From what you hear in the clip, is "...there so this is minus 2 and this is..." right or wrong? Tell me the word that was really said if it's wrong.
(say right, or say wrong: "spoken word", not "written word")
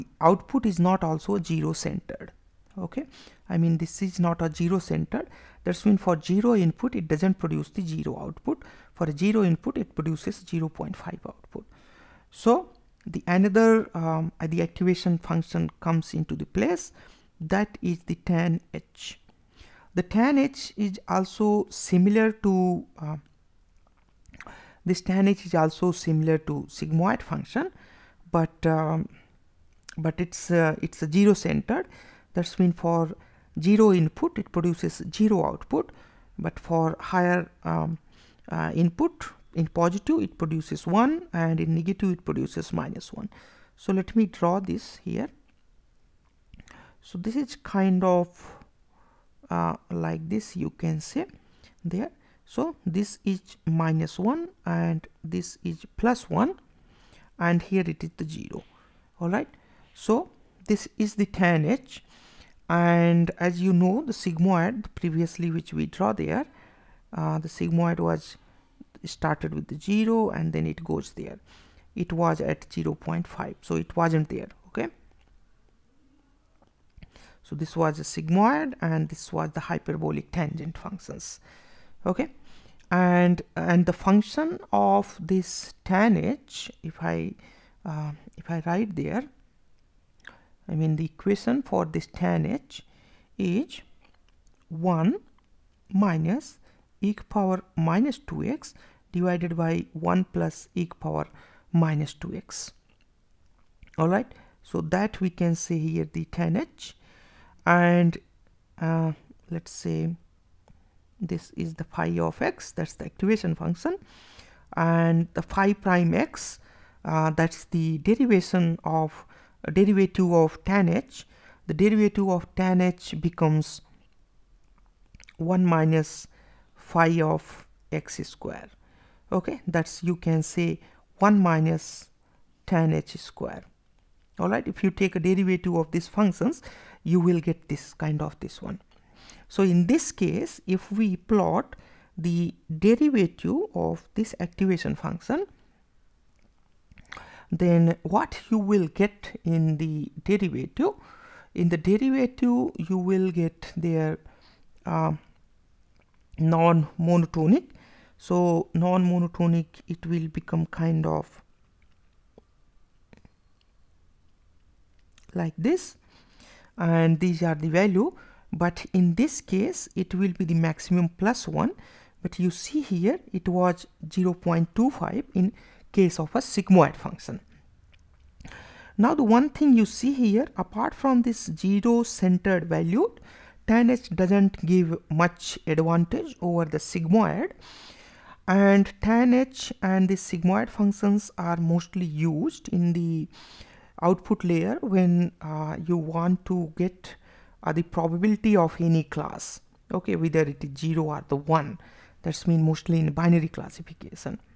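wrong: "1", not "2".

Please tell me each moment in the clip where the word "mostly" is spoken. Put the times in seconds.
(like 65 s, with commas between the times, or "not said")
191 s, 202 s.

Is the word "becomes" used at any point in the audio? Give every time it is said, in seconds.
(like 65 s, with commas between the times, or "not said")
123 s, 160 s.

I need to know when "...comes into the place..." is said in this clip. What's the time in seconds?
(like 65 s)
15 s.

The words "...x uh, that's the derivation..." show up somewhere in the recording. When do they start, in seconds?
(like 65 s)
116 s.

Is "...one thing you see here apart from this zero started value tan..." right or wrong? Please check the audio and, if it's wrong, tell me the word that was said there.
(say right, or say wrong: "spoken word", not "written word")
wrong: "centered", not "started".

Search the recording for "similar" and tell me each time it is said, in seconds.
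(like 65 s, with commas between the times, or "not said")
21 s, 25 s.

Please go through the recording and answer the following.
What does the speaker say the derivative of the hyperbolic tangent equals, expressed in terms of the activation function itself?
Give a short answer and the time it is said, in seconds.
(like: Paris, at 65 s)
1 minus phi of x square, at 125 s.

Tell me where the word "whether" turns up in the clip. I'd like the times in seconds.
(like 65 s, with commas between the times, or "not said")
200 s.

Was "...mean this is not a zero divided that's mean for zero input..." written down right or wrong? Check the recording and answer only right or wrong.
wrong.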